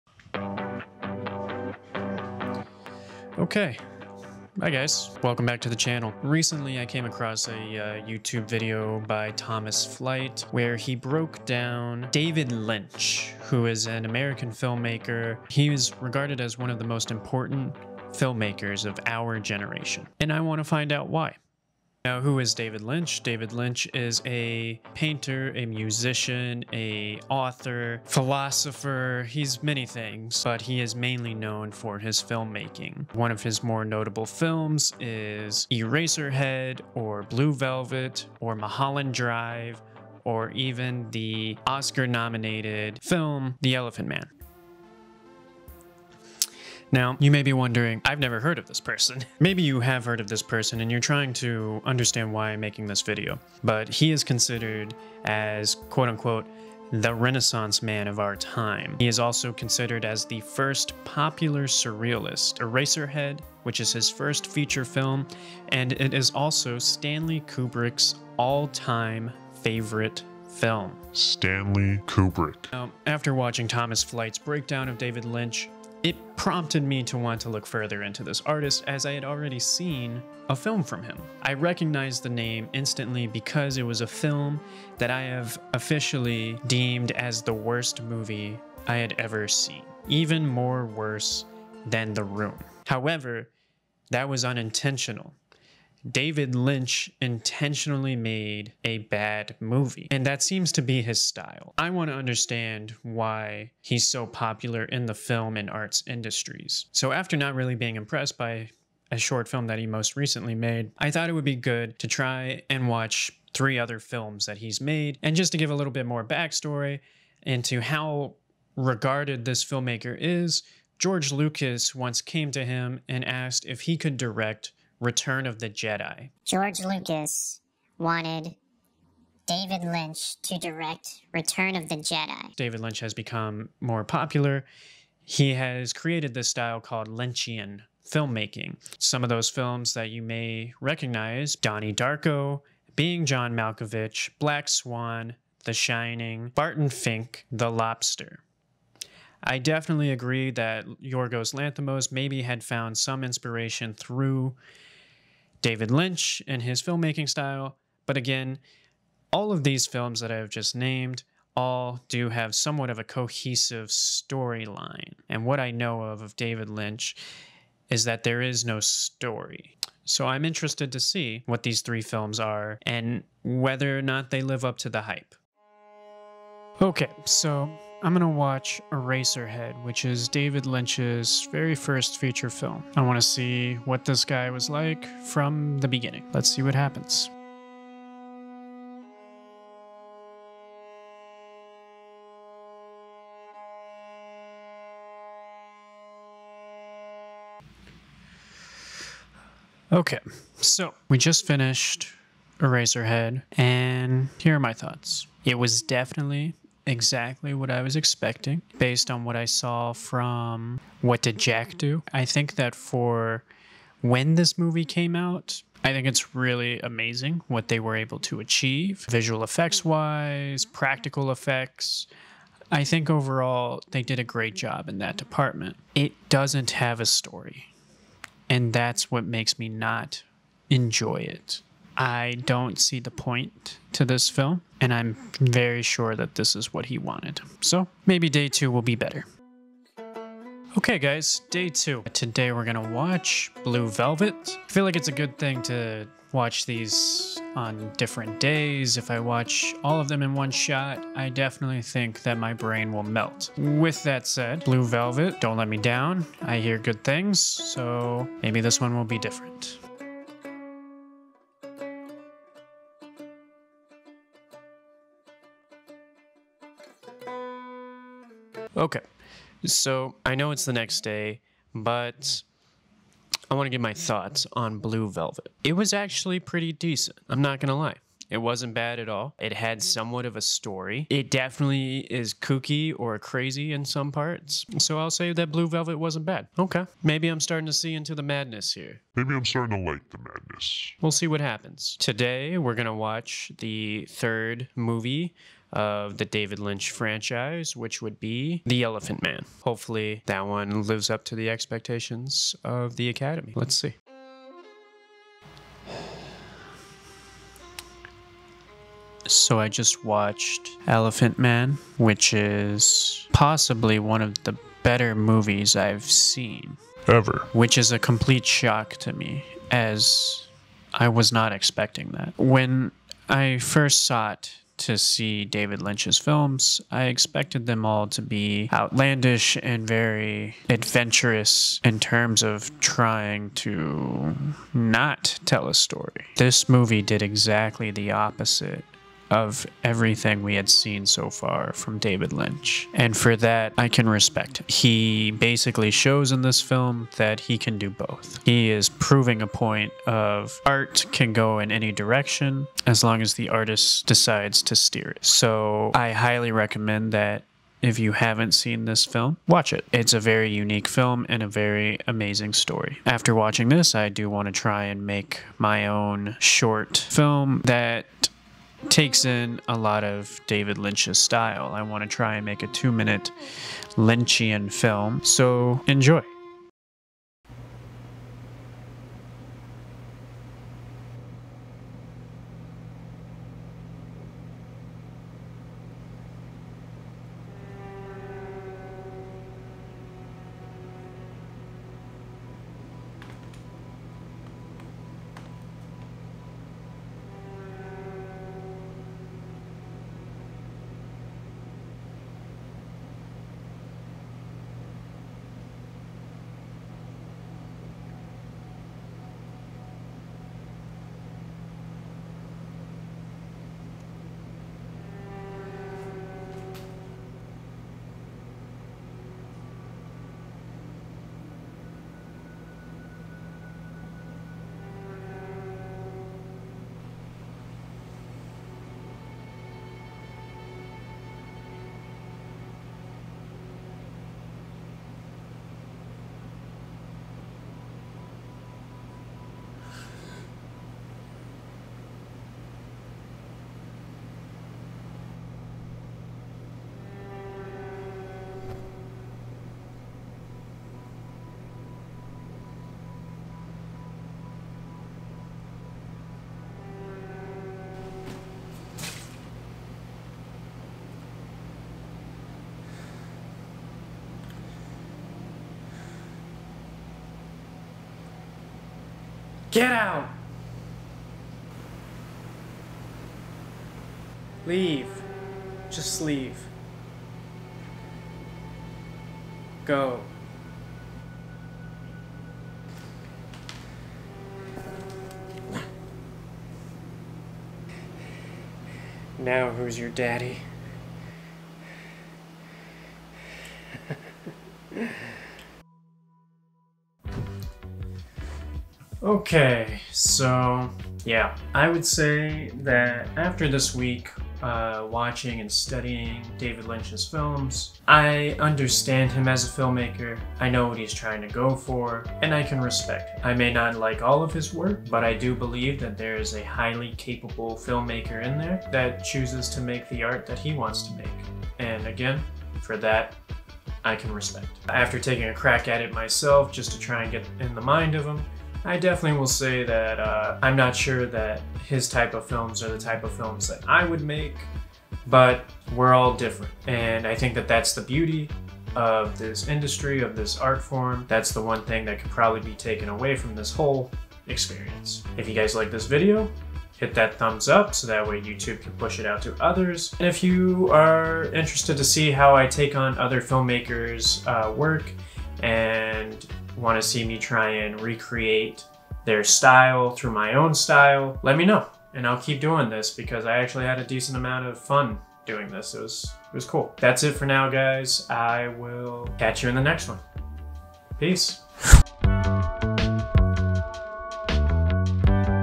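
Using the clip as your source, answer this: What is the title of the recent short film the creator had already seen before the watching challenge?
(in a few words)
What Did Jack Do?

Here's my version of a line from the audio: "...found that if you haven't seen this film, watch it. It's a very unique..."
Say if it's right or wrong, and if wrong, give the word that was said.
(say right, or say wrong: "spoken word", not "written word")
wrong: "recommend", not "found".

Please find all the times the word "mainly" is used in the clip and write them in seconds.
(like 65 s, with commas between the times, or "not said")
30 s.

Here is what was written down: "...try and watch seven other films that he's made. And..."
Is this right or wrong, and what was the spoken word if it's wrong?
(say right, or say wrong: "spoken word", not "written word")
wrong: "three", not "seven".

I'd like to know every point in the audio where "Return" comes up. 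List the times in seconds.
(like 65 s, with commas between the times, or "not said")
125 s, 131 s.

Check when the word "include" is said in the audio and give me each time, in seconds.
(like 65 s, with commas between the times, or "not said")
not said.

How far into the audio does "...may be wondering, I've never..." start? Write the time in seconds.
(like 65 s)
47 s.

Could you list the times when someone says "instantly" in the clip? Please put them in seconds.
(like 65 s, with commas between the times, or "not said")
82 s.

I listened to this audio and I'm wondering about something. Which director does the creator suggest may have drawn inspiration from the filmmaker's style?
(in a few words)
Yorgos Lanthimos.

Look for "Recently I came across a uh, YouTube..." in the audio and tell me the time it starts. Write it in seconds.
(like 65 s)
6 s.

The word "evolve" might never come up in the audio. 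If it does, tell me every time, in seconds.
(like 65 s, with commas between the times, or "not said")
not said.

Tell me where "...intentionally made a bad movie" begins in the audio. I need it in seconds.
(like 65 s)
97 s.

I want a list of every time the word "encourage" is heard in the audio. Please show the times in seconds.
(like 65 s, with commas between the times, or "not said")
not said.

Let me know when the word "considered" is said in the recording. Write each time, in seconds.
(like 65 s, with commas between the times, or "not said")
54 s, 59 s.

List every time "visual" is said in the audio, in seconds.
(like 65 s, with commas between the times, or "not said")
219 s.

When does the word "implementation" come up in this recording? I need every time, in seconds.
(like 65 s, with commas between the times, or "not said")
not said.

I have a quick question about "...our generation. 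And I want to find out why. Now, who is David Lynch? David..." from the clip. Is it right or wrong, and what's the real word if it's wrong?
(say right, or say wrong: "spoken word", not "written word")
right.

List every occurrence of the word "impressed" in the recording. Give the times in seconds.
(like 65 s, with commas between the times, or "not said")
107 s.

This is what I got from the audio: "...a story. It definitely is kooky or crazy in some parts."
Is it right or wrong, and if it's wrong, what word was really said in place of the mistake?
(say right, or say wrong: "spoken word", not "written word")
right.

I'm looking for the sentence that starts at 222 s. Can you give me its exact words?
I think overall they did a great job in that department.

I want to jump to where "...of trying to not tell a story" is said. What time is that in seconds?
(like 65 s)
332 s.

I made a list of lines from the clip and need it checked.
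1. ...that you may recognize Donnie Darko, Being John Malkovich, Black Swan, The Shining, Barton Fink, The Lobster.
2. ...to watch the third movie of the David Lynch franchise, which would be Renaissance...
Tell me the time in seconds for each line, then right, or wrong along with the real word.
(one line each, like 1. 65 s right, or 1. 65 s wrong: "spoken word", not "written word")
1. 139 s right
2. 292 s wrong: "The", not "Renaissance".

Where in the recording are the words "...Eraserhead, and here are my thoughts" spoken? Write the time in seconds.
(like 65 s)
202 s.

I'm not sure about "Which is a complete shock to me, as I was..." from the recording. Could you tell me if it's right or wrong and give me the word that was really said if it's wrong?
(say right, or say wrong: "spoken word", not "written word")
right.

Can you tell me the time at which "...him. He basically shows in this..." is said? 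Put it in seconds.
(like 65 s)
344 s.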